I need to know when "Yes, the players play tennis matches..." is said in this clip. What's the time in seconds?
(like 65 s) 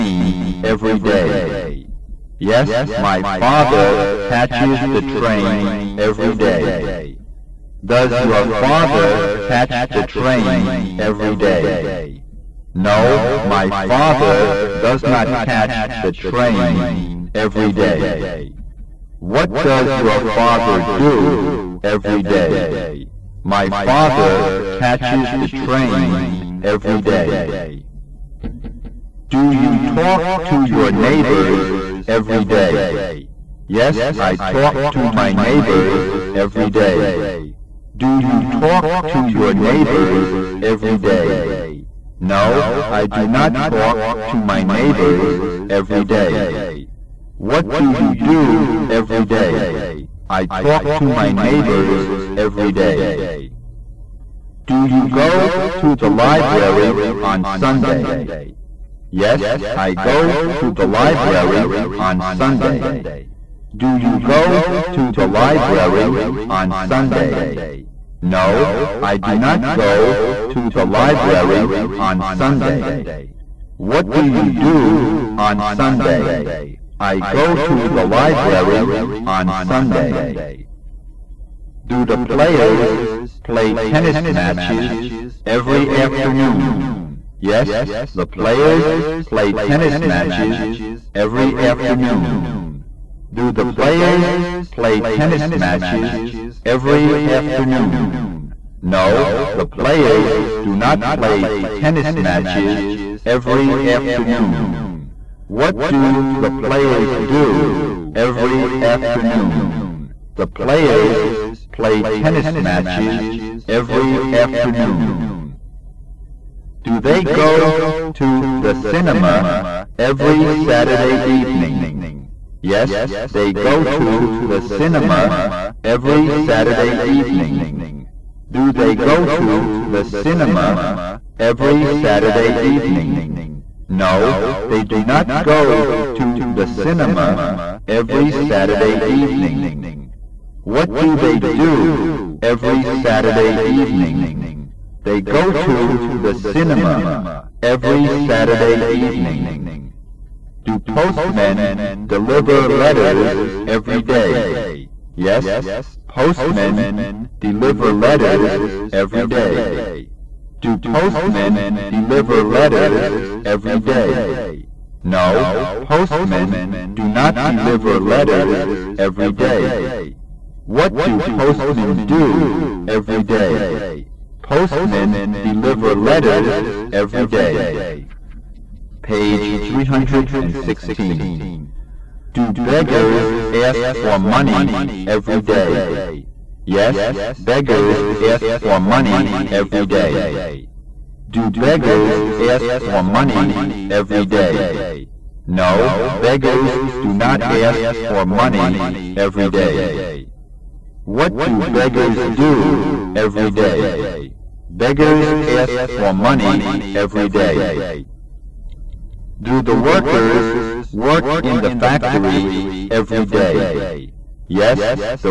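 87 s.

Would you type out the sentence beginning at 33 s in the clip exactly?
Yes, I talk to my neighbors every day.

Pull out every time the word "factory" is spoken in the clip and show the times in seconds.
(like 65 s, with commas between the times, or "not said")
211 s.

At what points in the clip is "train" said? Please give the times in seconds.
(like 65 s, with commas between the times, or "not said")
5 s, 10 s, 16 s, 25 s.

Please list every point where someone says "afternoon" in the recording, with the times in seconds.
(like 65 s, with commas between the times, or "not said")
85 s, 91 s, 97 s, 103 s, 108 s, 114 s.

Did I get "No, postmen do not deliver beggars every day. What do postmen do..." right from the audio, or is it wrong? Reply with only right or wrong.
wrong.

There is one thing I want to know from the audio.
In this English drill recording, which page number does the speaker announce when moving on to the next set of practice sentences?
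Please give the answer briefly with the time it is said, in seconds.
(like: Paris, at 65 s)
316, at 179 s.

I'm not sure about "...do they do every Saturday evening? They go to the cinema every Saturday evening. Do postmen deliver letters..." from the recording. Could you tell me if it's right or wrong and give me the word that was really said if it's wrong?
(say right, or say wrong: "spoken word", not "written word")
right.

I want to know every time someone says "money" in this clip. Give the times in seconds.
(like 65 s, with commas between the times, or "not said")
184 s, 188 s, 193 s, 198 s, 206 s.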